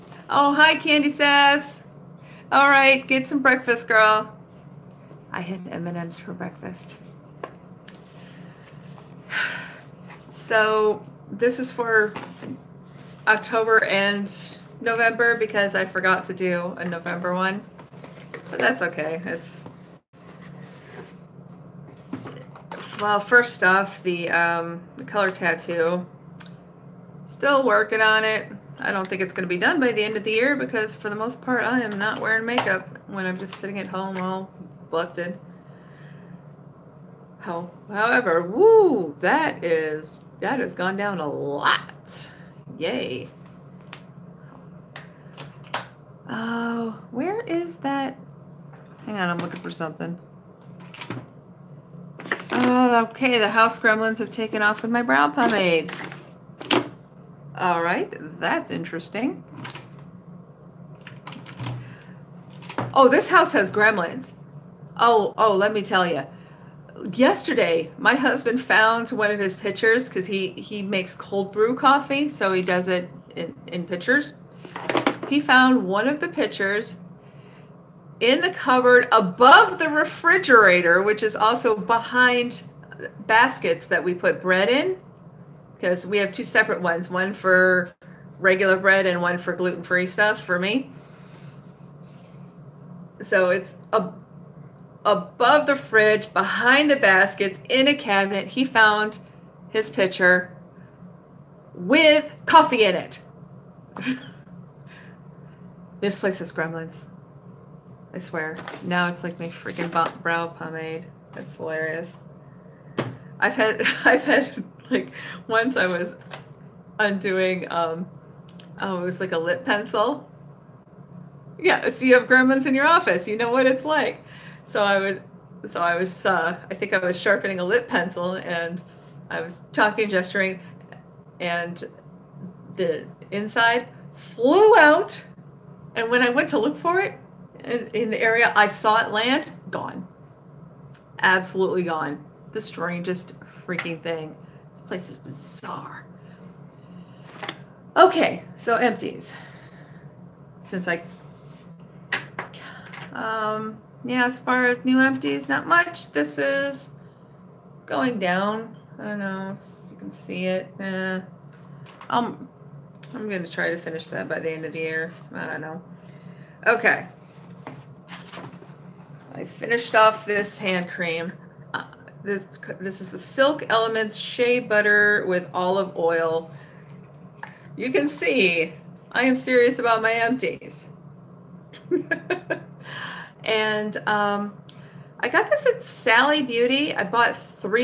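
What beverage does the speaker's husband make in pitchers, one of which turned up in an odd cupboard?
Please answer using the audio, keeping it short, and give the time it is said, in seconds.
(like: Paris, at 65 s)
Cold brew coffee, at 71 s.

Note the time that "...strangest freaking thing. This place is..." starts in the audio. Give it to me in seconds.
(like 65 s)
142 s.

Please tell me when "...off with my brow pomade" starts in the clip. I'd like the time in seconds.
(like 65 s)
54 s.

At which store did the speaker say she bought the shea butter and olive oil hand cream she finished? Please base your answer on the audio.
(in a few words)
Sally Beauty.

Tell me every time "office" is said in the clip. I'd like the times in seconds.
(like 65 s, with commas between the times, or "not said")
122 s.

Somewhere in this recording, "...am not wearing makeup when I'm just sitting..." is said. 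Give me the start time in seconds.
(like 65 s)
31 s.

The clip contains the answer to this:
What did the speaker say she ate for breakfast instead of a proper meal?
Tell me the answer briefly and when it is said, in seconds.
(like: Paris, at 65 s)
M&Ms, at 5 s.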